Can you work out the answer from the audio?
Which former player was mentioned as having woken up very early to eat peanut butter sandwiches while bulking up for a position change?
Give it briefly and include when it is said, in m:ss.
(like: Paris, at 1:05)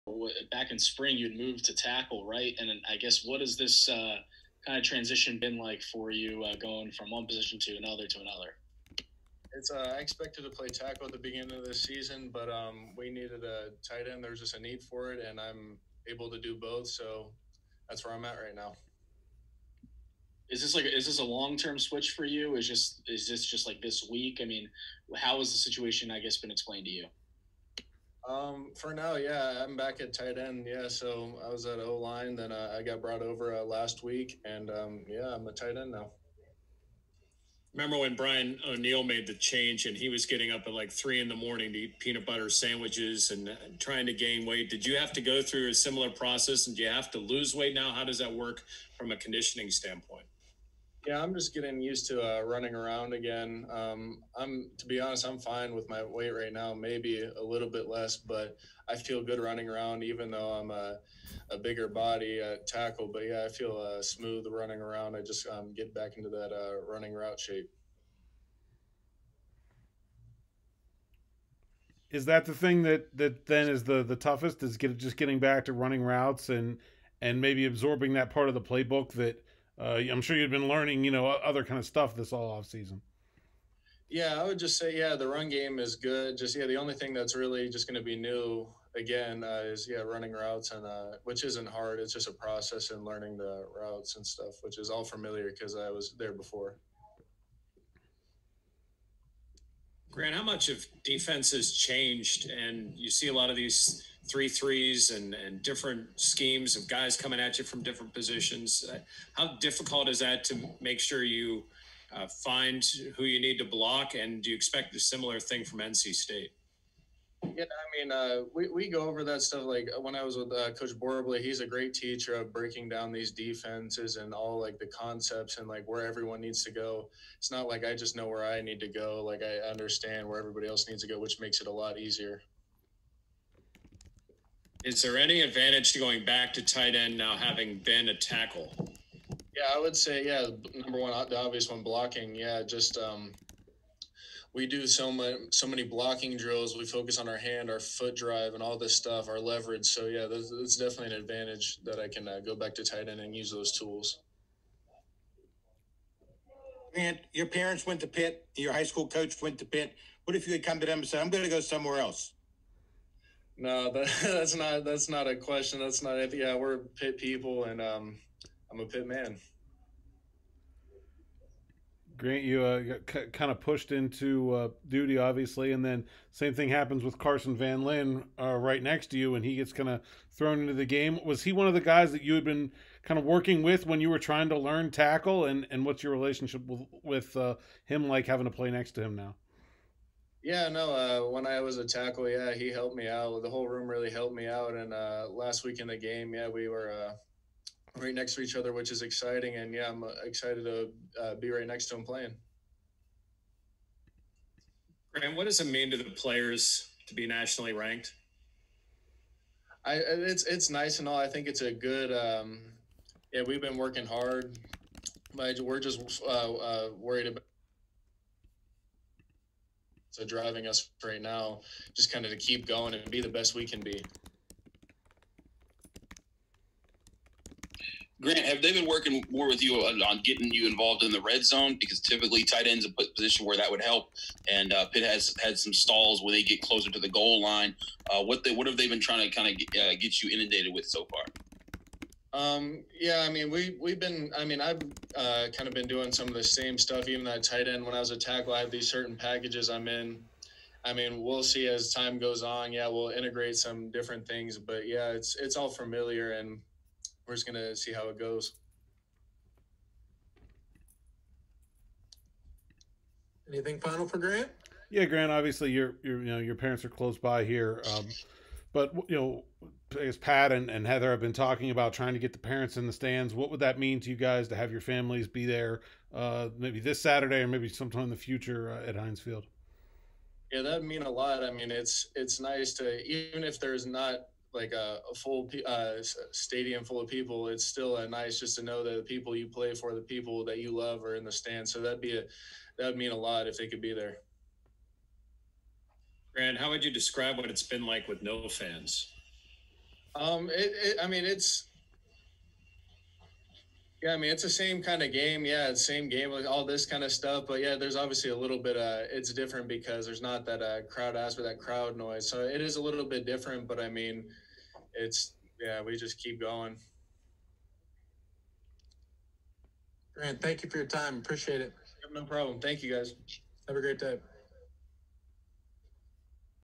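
Brian O'Neill, at 0:38.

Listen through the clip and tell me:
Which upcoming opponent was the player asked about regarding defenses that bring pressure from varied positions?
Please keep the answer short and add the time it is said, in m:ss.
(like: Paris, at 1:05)
NC State, at 1:55.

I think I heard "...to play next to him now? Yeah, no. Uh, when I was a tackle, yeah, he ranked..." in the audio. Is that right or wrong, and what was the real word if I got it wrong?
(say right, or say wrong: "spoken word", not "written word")
wrong: "helped", not "ranked".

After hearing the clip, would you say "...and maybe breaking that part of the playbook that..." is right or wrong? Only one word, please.
wrong.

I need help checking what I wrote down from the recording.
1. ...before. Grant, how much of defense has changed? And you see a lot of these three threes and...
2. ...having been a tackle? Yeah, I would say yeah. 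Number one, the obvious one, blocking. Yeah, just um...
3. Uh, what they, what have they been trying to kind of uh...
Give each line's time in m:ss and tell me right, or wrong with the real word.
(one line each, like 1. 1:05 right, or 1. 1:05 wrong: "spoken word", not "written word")
1. 1:36 right
2. 2:17 right
3. 3:58 right.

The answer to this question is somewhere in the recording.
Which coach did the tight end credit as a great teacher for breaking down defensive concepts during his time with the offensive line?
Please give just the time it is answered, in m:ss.
2:00.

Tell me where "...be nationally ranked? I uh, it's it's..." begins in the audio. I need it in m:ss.
3:27.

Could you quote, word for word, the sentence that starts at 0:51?
Yeah, I'm just getting used to uh, running around again.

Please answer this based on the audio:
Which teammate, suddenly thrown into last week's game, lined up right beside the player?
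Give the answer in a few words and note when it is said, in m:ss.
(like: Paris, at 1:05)
Carson Van Lynn, at 2:57.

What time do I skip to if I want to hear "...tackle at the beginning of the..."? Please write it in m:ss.
0:10.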